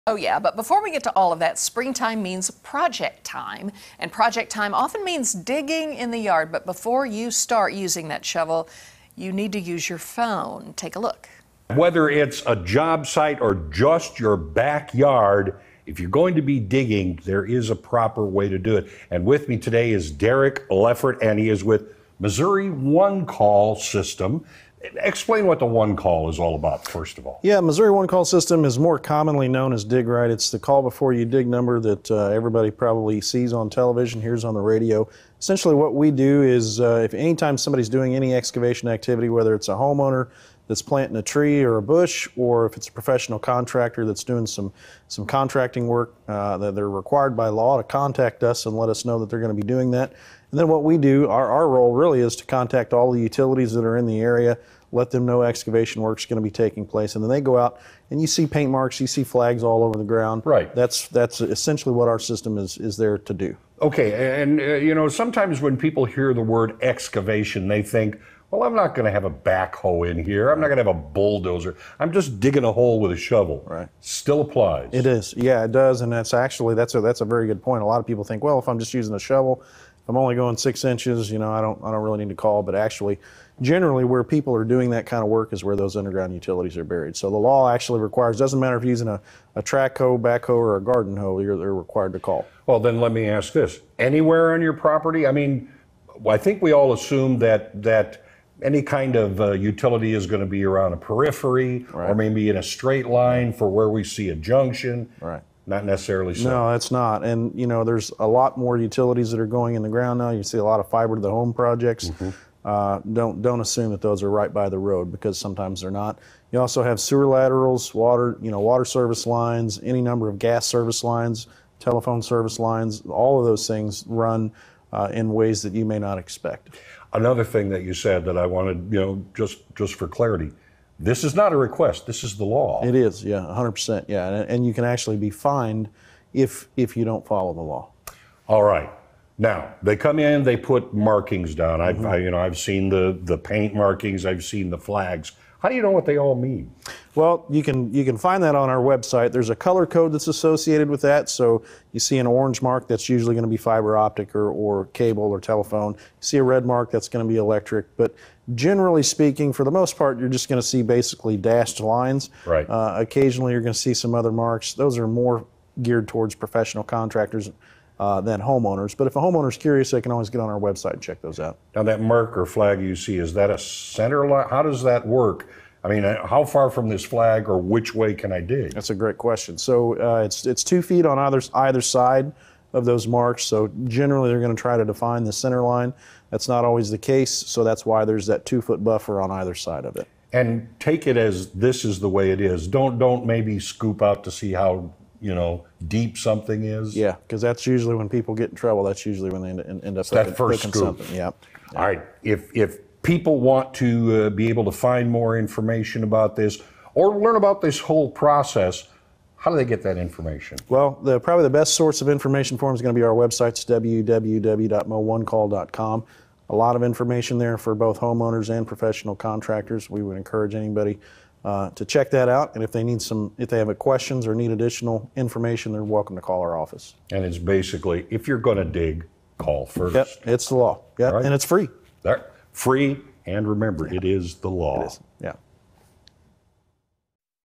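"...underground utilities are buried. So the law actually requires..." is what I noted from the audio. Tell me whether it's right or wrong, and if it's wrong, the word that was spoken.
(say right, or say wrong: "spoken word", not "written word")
right.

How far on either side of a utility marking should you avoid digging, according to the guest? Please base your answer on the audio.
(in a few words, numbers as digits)
2 feet.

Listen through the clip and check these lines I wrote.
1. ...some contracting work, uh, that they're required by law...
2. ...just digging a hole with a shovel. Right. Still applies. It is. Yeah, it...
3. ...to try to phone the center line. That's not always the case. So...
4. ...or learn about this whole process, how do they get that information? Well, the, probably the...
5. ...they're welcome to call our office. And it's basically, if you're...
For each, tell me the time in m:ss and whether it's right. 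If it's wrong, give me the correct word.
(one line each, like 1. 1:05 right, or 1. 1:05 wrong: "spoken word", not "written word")
1. 0:45 right
2. 1:12 right
3. 3:04 wrong: "define", not "phone"
4. 3:26 right
5. 3:45 right.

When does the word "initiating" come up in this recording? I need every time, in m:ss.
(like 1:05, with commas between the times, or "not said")
not said.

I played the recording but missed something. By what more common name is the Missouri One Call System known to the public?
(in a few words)
Dig Right.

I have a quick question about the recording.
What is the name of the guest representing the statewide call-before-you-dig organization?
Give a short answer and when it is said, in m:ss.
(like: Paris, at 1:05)
Derek Leffert, at 0:20.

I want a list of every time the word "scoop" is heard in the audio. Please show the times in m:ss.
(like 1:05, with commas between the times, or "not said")
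3:13, 3:20.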